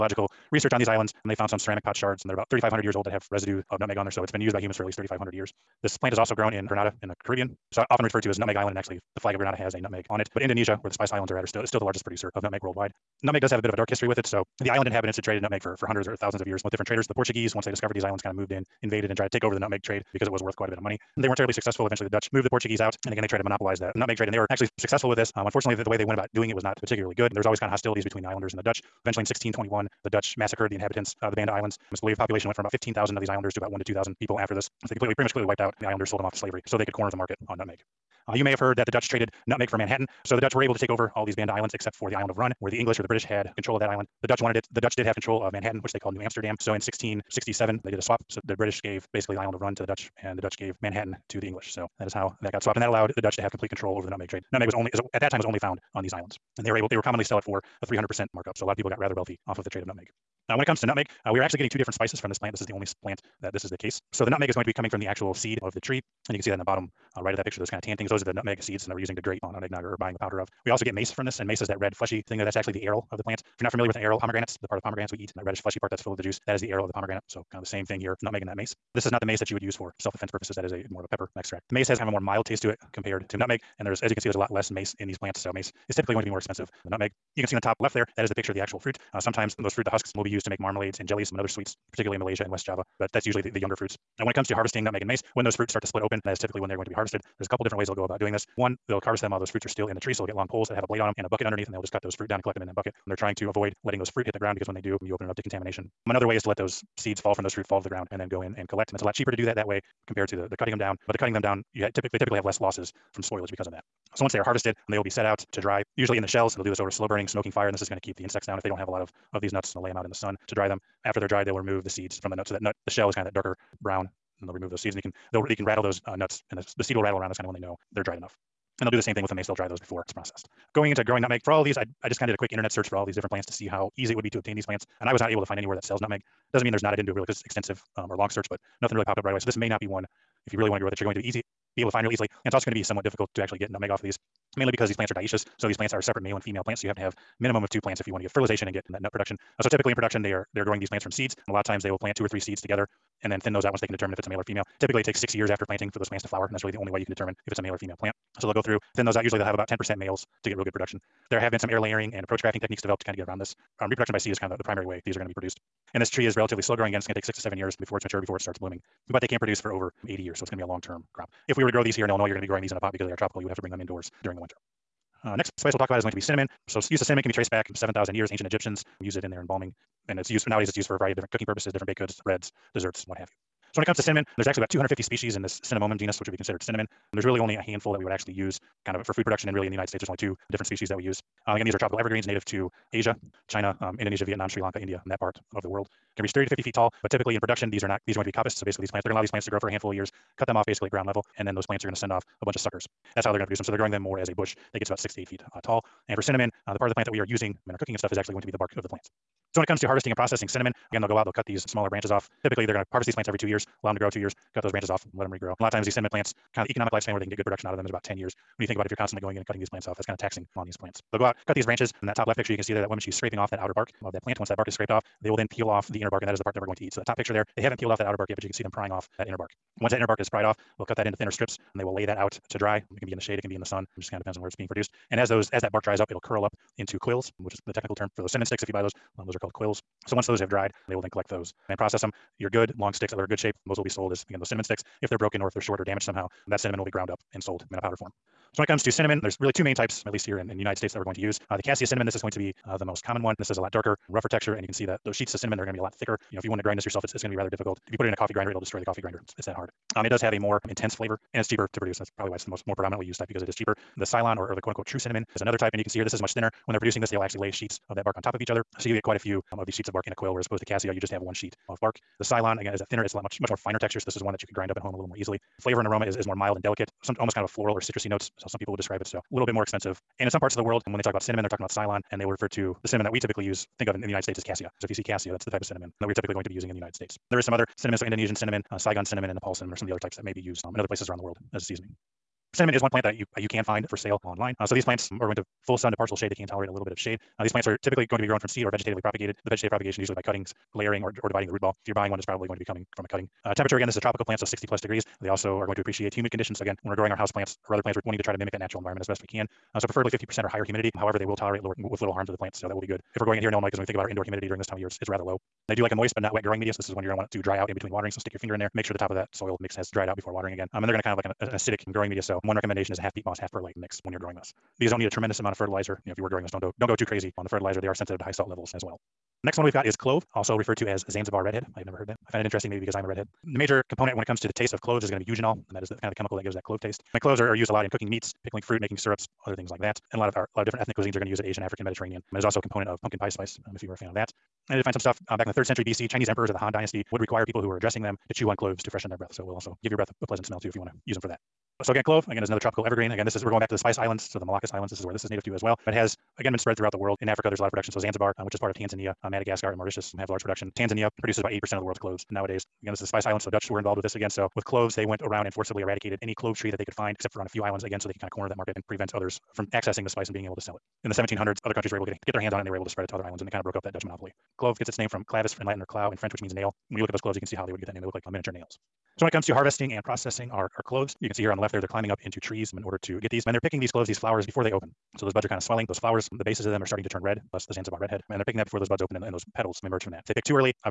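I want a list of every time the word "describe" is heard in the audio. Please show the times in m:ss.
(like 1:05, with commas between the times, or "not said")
4:38.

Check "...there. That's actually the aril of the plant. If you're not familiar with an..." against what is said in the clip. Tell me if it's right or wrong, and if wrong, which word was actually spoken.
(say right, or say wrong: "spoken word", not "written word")
right.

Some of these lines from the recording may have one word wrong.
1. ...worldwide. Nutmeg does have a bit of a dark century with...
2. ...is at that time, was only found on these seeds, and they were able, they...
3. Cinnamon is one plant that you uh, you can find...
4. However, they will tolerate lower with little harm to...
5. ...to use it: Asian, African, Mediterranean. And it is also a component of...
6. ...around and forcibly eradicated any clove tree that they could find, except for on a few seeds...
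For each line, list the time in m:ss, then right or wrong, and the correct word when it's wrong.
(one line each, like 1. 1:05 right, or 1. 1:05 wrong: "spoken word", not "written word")
1. 0:12 wrong: "history", not "century"
2. 0:54 wrong: "islands", not "seeds"
3. 4:52 right
4. 5:10 right
5. 5:41 right
6. 6:05 wrong: "islands", not "seeds".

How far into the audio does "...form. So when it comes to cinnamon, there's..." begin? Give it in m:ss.
4:07.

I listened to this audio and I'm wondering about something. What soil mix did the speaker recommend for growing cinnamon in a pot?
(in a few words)
half peat moss, half perlite.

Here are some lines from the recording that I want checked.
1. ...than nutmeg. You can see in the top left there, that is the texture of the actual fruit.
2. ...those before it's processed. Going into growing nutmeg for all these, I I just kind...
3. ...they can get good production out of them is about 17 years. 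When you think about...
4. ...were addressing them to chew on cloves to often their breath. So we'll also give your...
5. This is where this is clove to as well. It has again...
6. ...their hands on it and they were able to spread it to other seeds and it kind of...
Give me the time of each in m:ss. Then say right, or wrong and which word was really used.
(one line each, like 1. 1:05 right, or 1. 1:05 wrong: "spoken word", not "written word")
1. 1:26 wrong: "picture", not "texture"
2. 2:09 right
3. 3:37 wrong: "10", not "17"
4. 5:47 wrong: "freshen", not "often"
5. 5:54 wrong: "native", not "clove"
6. 6:12 wrong: "islands", not "seeds".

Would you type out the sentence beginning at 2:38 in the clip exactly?
So they'll go through, thin those out.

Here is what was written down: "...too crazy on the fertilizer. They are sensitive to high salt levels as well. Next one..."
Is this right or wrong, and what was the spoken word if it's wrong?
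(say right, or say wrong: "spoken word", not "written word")
right.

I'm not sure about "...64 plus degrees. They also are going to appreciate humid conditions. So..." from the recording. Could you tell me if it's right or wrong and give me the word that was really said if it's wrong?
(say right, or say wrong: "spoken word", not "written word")
wrong: "60", not "64".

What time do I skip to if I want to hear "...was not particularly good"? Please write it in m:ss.
0:26.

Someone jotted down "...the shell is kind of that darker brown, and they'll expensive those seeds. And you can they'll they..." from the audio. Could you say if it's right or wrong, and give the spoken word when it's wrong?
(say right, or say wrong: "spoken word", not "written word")
wrong: "remove", not "expensive".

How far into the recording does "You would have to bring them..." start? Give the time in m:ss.
2:53.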